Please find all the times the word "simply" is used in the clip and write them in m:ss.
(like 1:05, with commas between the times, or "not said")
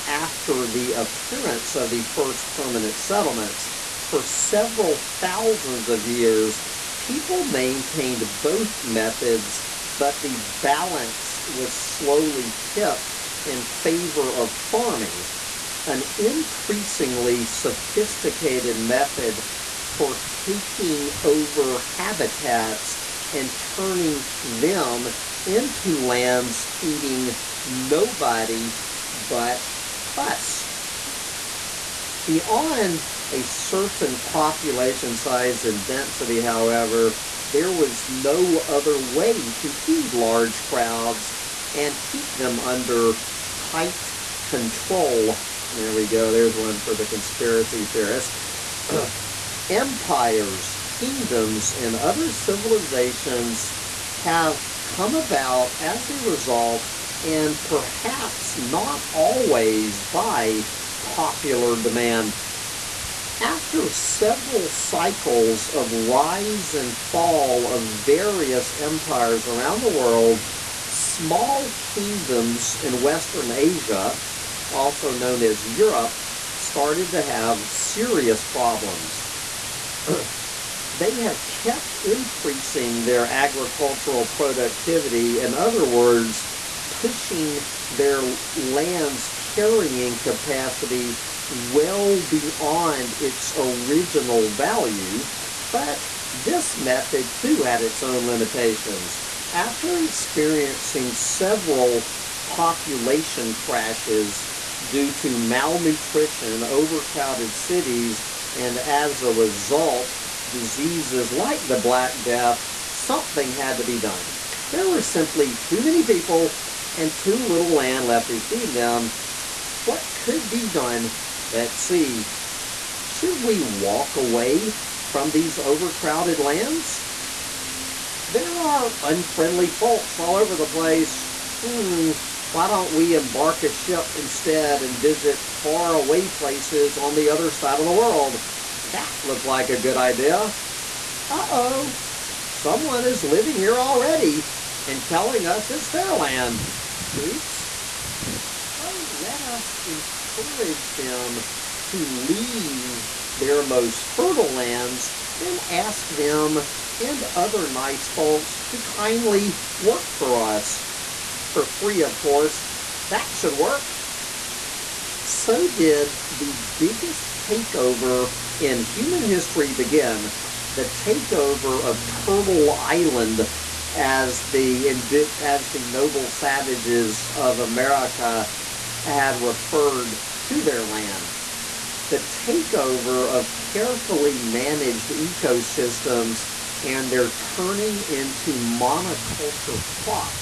1:55.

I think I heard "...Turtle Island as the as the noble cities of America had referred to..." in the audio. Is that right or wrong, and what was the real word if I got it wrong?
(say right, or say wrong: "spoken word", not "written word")
wrong: "savages", not "cities".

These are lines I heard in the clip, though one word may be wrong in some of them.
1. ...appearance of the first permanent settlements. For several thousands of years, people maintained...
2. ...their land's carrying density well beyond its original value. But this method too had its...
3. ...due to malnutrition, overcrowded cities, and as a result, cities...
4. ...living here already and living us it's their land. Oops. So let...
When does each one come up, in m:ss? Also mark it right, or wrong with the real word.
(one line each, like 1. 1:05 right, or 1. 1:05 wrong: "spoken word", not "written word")
1. 0:00 right
2. 1:27 wrong: "capacity", not "density"
3. 1:44 wrong: "diseases", not "cities"
4. 2:23 wrong: "telling", not "living".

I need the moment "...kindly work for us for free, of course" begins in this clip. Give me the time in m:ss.
2:38.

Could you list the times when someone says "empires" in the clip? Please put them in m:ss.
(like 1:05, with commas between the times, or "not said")
0:49, 1:08.